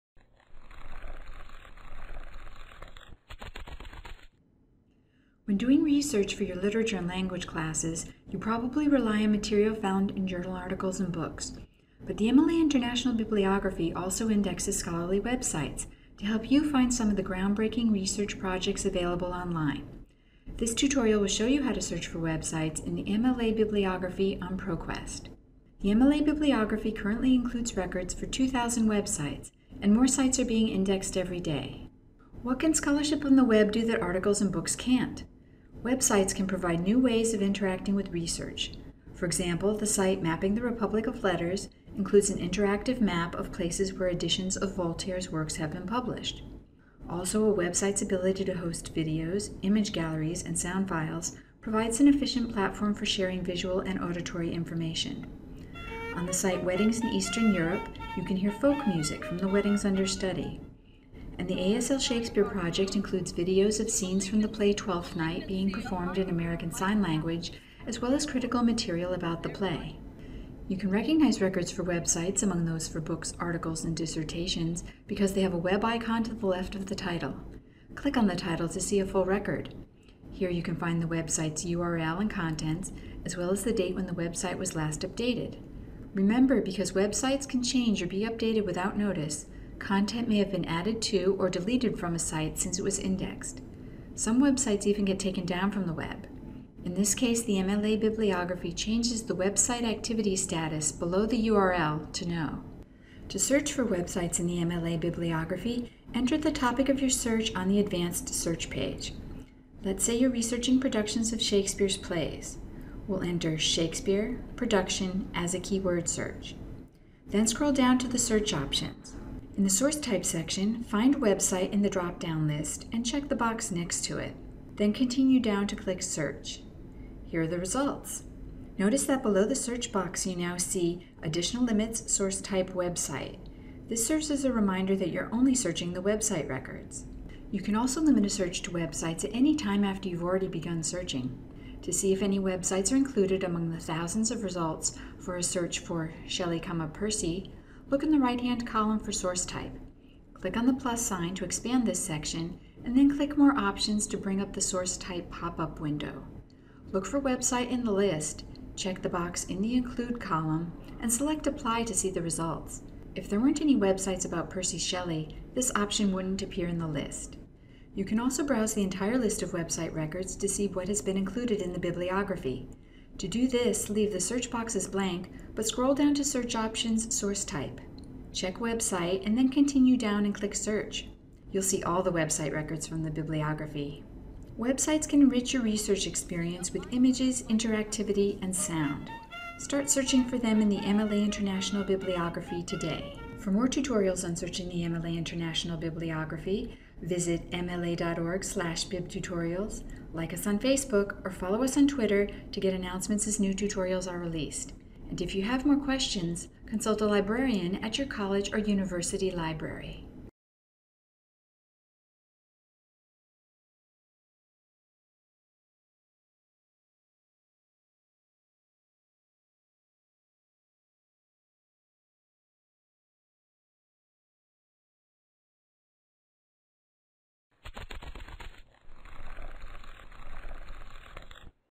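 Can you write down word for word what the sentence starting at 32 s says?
What can scholarship on the web do that articles and books can't?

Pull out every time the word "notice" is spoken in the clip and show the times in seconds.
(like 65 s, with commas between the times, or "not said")
88 s, 128 s.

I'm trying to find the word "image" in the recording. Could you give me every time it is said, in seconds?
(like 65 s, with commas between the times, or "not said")
49 s, 186 s.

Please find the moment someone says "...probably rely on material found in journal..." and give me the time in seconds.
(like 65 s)
8 s.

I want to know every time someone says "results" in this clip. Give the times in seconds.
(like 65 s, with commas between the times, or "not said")
127 s, 144 s, 162 s.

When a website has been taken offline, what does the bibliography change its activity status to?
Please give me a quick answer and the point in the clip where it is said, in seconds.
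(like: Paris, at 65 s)
No, at 102 s.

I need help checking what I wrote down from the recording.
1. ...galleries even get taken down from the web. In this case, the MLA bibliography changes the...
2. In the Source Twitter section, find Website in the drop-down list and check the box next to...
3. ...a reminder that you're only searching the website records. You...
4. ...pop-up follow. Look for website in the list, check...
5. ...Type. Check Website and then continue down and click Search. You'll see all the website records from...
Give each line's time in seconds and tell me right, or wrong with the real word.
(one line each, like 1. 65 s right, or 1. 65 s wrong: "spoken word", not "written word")
1. 94 s wrong: "websites", not "galleries"
2. 119 s wrong: "Type", not "Twitter"
3. 134 s right
4. 155 s wrong: "window", not "follow"
5. 177 s right.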